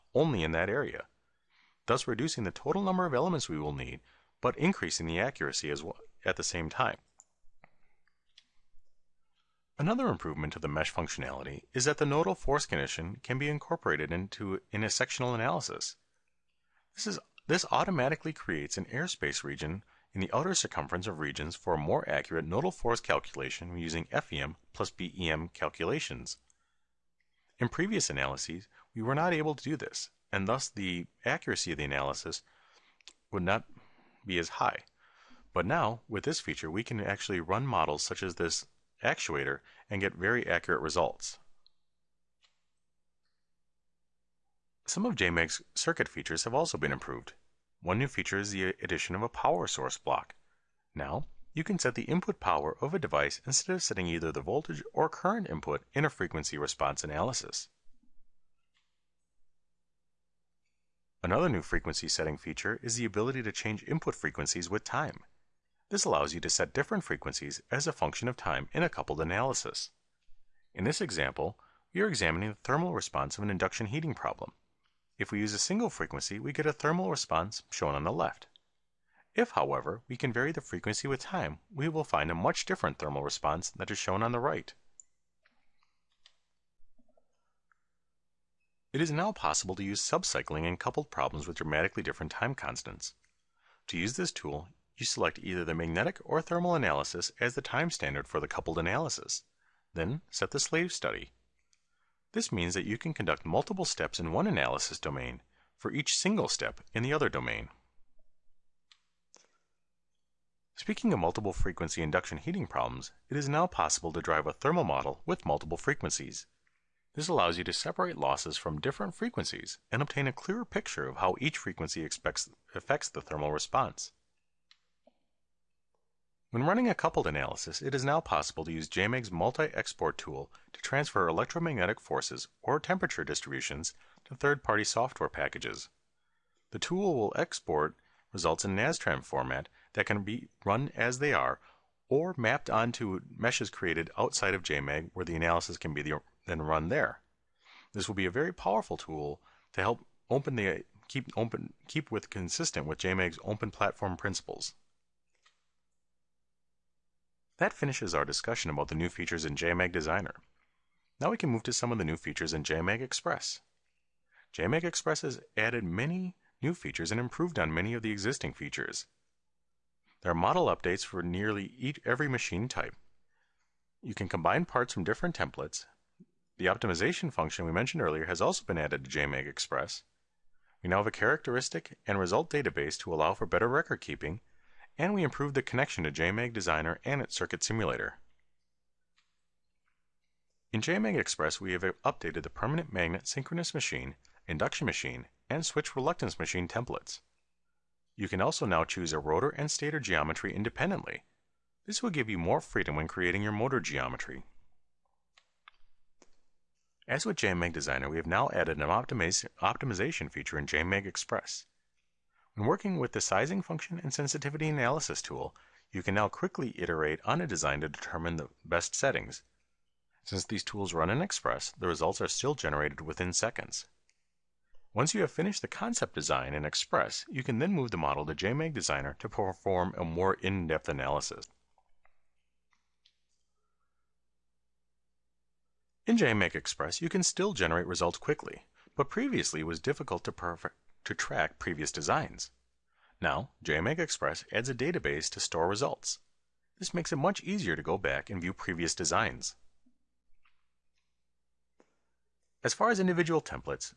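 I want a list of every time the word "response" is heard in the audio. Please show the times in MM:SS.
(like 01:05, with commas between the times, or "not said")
00:56, 01:12, 01:17, 01:23, 02:03.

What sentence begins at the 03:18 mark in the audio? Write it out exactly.
You can also now choose a rotor and stator geometry independently.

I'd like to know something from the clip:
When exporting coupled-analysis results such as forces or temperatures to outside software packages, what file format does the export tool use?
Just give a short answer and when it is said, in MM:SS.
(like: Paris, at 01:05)
NASTRAN, at 02:18.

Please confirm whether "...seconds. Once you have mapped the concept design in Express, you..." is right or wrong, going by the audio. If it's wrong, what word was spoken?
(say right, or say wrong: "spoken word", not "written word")
wrong: "finished", not "mapped".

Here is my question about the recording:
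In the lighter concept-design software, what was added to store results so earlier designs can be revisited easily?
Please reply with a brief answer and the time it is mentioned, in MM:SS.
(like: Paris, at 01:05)
a database, at 04:04.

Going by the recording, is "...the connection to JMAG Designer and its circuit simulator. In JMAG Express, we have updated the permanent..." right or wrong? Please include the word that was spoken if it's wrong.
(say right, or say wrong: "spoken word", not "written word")
right.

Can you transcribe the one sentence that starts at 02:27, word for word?
This will be a very powerful tool to help open the keep open keep with consistent with JMAG's open platform principles.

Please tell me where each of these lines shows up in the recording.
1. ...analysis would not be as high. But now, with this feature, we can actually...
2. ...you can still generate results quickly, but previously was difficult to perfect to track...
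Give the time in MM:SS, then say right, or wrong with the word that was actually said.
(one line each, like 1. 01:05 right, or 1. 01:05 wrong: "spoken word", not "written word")
1. 00:31 right
2. 03:57 right.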